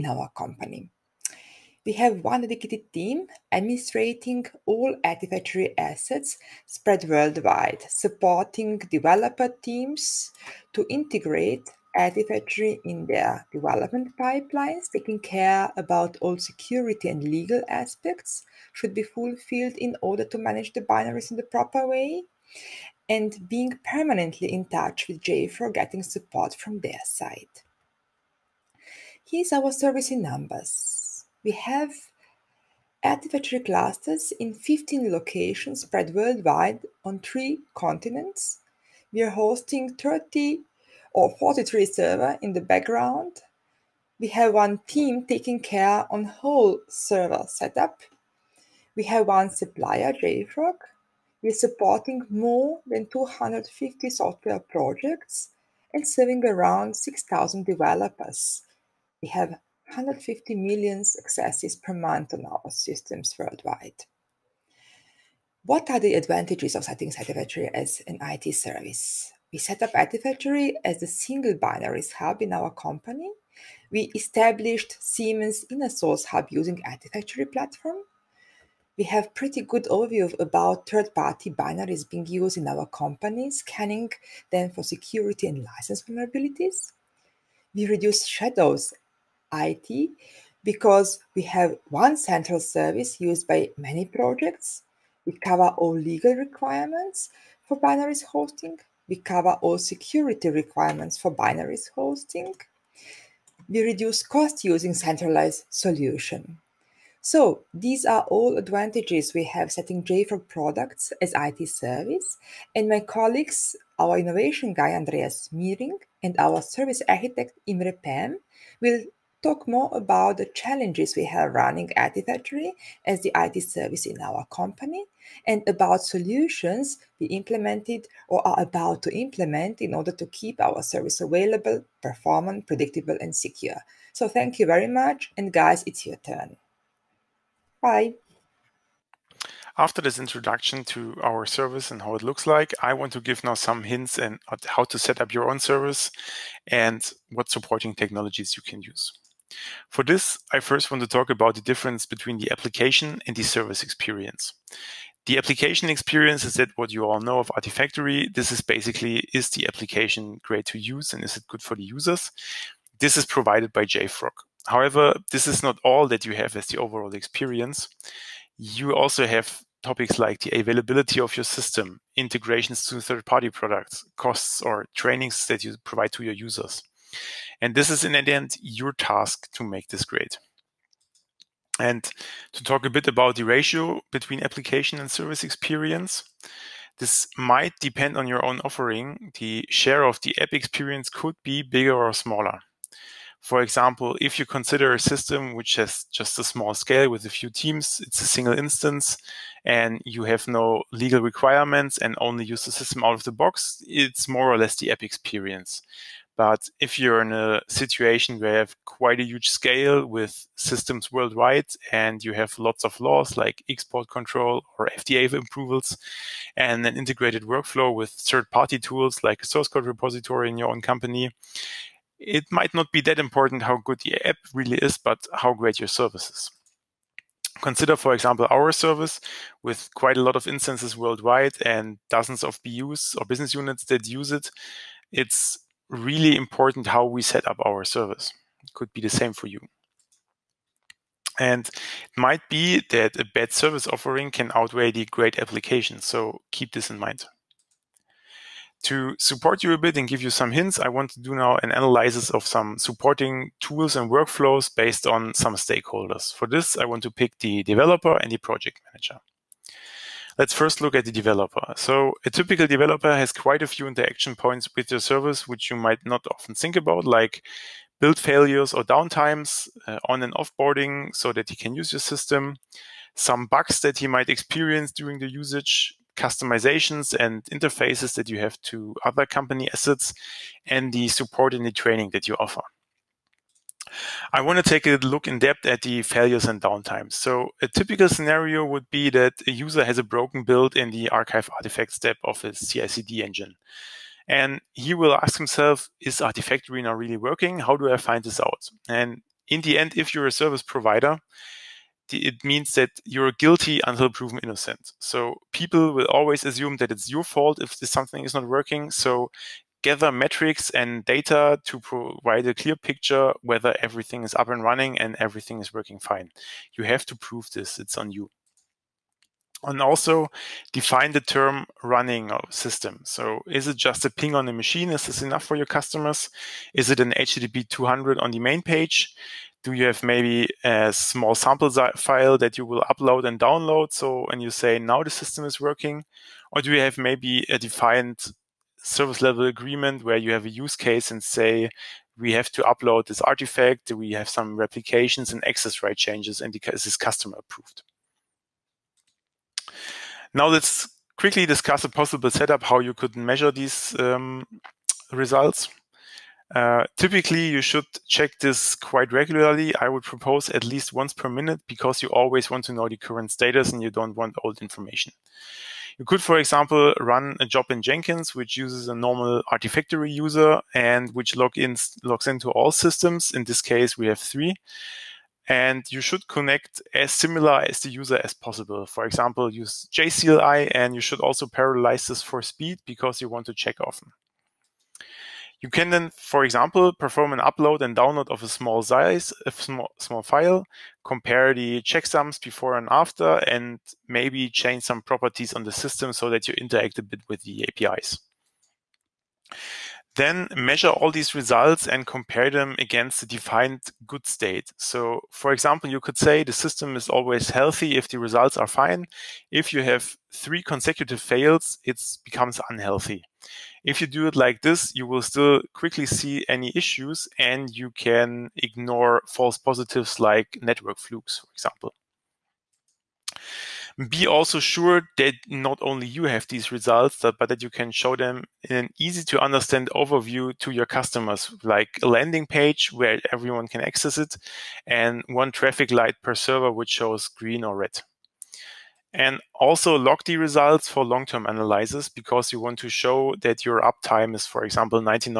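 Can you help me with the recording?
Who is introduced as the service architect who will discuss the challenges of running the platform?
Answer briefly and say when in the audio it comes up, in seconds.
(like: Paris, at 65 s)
Imre Pam, at 117 s.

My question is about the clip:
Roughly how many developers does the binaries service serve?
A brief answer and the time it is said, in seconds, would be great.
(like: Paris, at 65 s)
6,000, at 56 s.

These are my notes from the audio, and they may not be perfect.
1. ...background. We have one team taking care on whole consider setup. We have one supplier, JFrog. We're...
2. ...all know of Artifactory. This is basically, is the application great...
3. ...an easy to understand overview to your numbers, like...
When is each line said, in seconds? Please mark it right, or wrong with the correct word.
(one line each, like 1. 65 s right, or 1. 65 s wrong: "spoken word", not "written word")
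1. 42 s wrong: "server", not "consider"
2. 157 s right
3. 428 s wrong: "customers", not "numbers".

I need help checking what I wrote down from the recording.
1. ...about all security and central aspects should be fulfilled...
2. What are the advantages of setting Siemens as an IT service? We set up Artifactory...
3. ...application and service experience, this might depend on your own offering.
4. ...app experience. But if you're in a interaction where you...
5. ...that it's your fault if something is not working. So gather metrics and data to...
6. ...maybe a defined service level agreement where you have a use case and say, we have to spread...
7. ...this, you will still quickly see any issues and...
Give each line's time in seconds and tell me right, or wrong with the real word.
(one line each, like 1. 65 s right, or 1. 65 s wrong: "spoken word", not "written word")
1. 15 s wrong: "legal", not "central"
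2. 65 s wrong: "Artifactory", not "Siemens"
3. 184 s right
4. 204 s wrong: "situation", not "interaction"
5. 306 s right
6. 336 s wrong: "upload", not "spread"
7. 414 s right.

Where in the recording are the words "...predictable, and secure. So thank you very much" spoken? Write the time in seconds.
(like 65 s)
132 s.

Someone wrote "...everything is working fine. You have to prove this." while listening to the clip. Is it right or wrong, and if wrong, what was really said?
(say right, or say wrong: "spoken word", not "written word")
right.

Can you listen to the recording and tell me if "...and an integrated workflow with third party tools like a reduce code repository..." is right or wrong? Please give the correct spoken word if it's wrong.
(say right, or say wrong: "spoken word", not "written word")
wrong: "source", not "reduce".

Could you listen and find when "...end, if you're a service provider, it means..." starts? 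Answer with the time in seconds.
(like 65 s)
299 s.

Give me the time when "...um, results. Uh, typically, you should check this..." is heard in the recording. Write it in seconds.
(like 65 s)
353 s.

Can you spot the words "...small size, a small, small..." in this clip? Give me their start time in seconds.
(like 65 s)
388 s.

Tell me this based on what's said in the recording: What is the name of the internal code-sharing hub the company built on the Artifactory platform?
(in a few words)
Siemens Inner Source Hub.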